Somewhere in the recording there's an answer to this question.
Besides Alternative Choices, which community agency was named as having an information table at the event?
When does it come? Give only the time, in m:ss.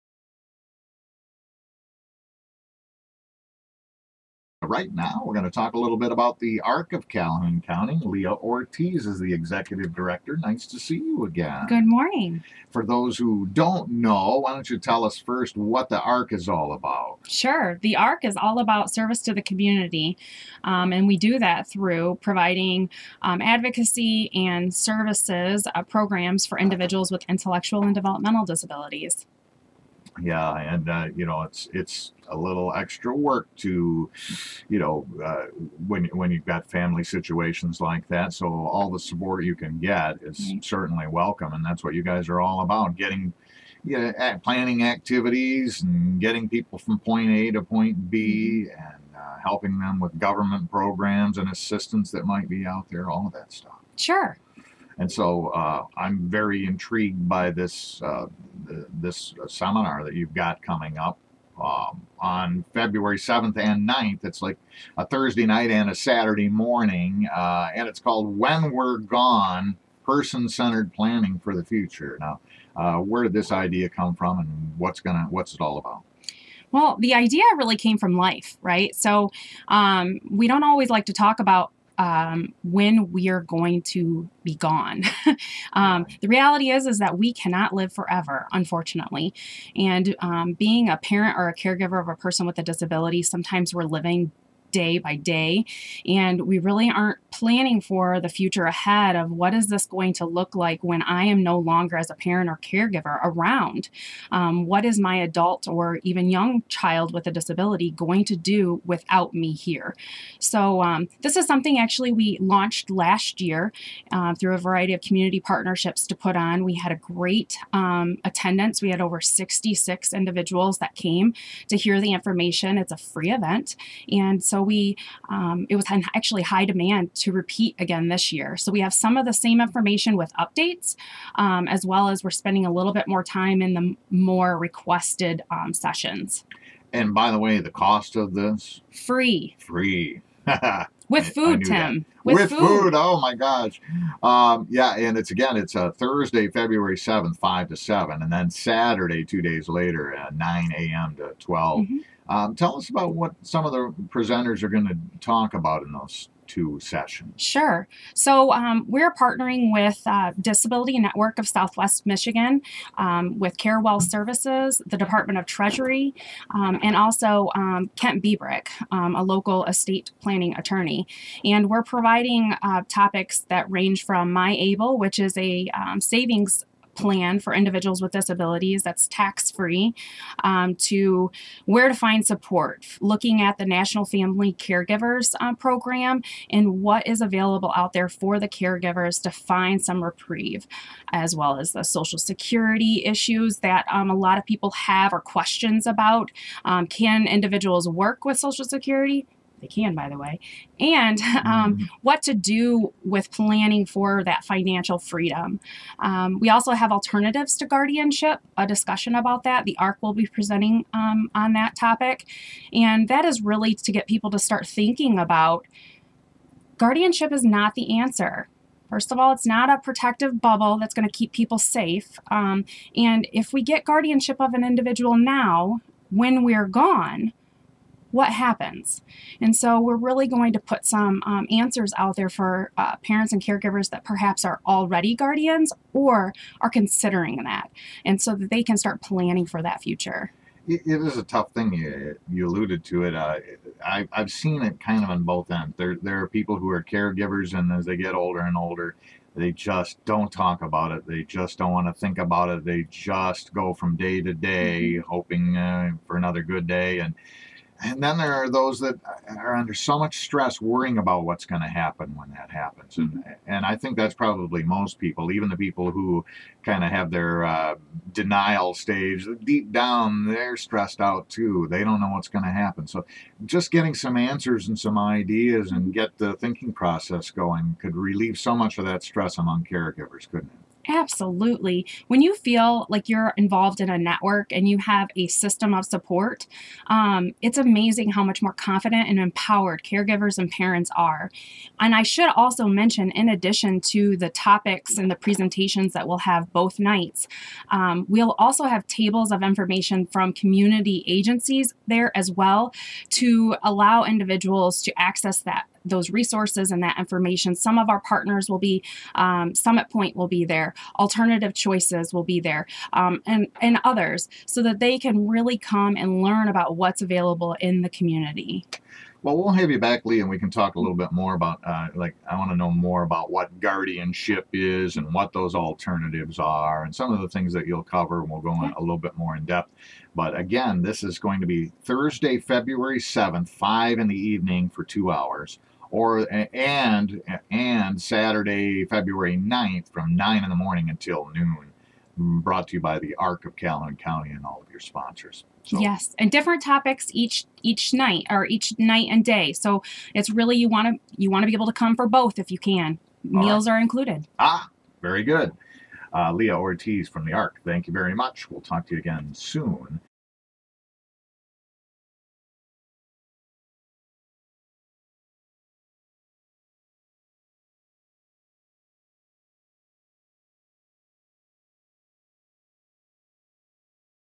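5:09.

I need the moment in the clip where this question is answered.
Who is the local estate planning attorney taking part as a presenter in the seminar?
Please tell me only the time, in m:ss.
2:47.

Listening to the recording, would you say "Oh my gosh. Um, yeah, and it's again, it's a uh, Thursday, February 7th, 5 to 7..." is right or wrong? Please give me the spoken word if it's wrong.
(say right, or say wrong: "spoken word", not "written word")
right.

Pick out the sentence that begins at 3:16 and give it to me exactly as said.
Um, can individuals work with Social Security?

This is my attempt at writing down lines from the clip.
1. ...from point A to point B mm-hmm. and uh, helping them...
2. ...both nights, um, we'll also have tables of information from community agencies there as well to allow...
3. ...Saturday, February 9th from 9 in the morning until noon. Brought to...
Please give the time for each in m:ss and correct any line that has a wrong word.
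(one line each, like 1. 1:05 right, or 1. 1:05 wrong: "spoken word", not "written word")
1. 0:46 right
2. 4:56 right
3. 5:38 right.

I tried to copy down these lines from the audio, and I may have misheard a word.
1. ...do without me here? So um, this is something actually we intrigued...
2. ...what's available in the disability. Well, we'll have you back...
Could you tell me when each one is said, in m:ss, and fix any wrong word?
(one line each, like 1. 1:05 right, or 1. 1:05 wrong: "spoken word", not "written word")
1. 1:48 wrong: "launched", not "intrigued"
2. 5:16 wrong: "community", not "disability".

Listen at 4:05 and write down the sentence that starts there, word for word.
There, there are people who are caregivers, and as they get older and older, they just don't talk about it.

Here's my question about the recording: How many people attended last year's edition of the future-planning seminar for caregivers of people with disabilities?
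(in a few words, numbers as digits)
66.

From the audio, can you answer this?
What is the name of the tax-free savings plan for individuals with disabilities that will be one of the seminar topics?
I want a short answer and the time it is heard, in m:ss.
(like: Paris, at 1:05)
MiABLE, at 2:54.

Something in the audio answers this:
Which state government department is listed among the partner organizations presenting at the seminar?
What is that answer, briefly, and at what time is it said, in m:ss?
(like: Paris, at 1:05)
Department of Treasury, at 2:44.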